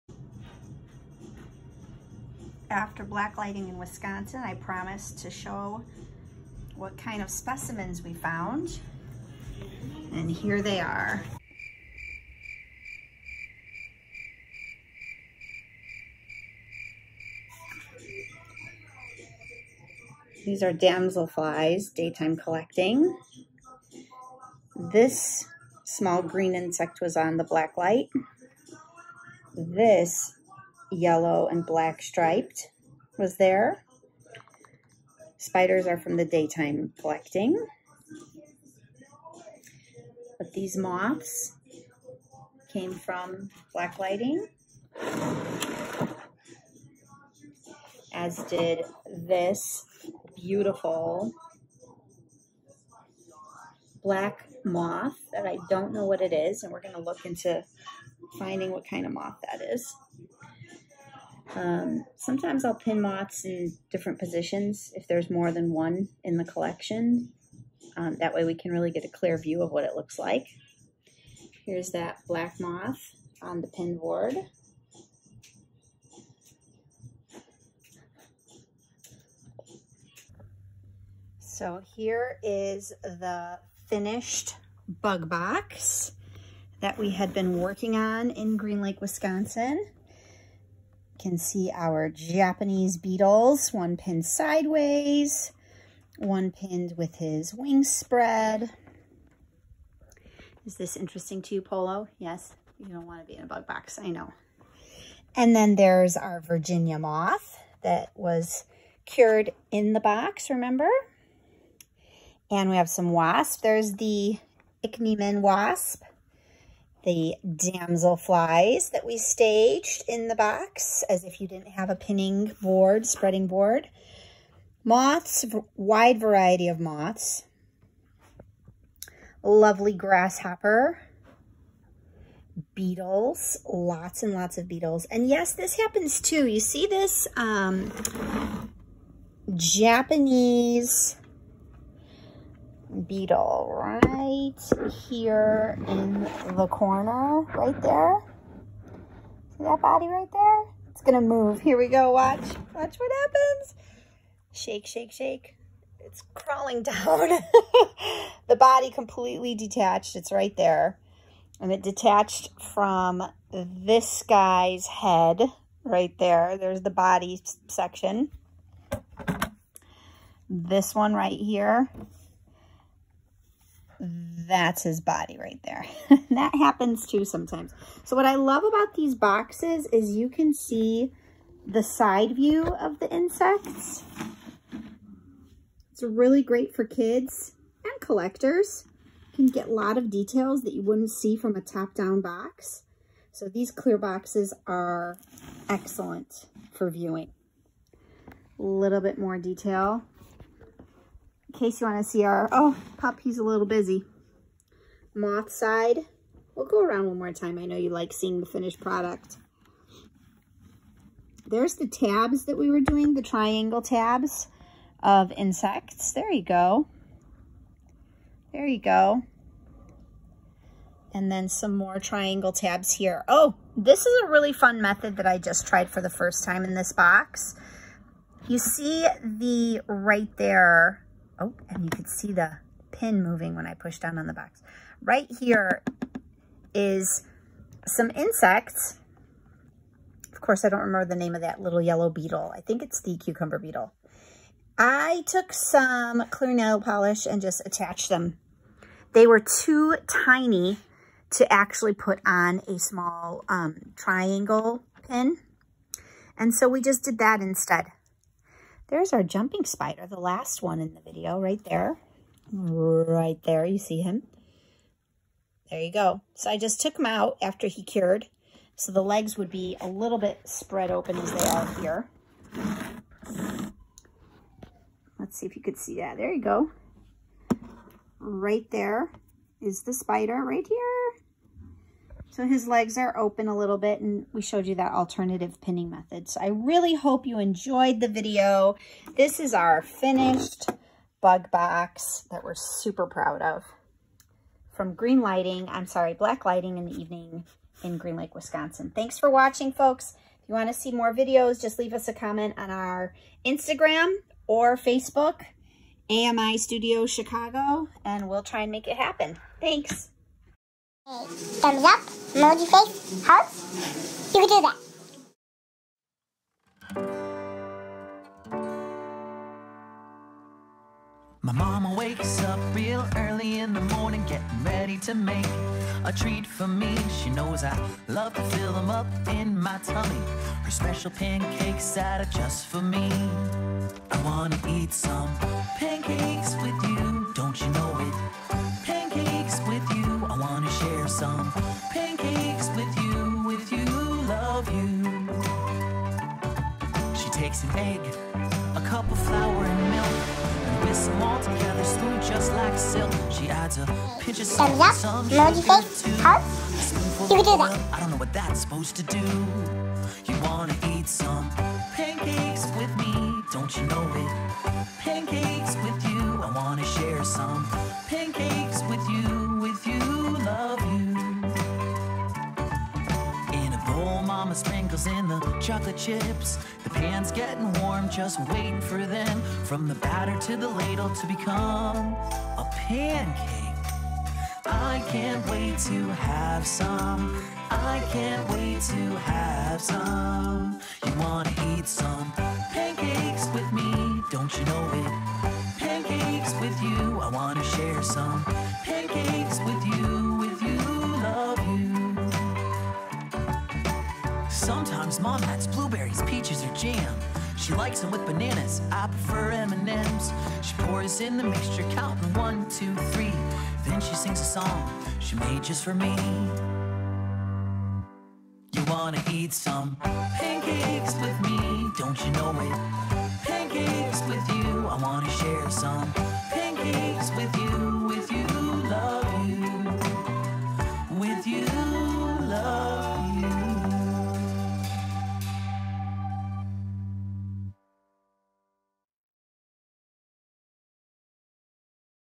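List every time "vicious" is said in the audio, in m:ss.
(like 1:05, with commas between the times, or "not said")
not said.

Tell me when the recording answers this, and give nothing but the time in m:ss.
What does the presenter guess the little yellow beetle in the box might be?
4:03.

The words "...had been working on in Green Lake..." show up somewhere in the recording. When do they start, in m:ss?
1:27.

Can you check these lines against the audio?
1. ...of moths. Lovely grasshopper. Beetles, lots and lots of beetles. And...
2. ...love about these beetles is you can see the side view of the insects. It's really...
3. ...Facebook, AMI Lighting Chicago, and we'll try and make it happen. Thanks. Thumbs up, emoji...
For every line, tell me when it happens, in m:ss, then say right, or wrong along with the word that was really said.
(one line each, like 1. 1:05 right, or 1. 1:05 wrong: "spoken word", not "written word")
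1. 2:06 right
2. 2:58 wrong: "boxes", not "beetles"
3. 5:04 wrong: "Studio", not "Lighting".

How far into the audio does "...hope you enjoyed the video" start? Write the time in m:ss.
4:46.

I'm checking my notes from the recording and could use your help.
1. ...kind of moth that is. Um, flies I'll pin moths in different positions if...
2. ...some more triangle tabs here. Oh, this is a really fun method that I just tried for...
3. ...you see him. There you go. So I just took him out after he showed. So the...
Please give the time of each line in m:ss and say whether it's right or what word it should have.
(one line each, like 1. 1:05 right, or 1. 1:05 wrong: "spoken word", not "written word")
1. 0:58 wrong: "sometimes", not "flies"
2. 3:41 right
3. 4:23 wrong: "cured", not "showed".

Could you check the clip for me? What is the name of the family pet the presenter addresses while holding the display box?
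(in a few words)
Polo.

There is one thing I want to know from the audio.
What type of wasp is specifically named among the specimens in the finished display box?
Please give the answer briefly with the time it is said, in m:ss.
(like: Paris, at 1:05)
Ichneumon wasp, at 1:54.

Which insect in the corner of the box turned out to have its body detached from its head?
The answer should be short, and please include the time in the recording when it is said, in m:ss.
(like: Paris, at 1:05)
Japanese beetle, at 2:19.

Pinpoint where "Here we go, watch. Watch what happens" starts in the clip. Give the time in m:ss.
2:31.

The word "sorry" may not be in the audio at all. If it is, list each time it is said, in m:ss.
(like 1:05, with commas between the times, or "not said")
4:55.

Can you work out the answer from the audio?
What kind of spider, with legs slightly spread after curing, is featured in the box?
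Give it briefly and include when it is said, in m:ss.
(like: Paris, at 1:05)
jumping spider, at 4:19.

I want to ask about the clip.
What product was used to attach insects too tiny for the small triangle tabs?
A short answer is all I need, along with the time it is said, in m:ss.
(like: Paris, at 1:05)
clear nail polish, at 4:06.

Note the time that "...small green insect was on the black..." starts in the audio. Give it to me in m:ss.
0:25.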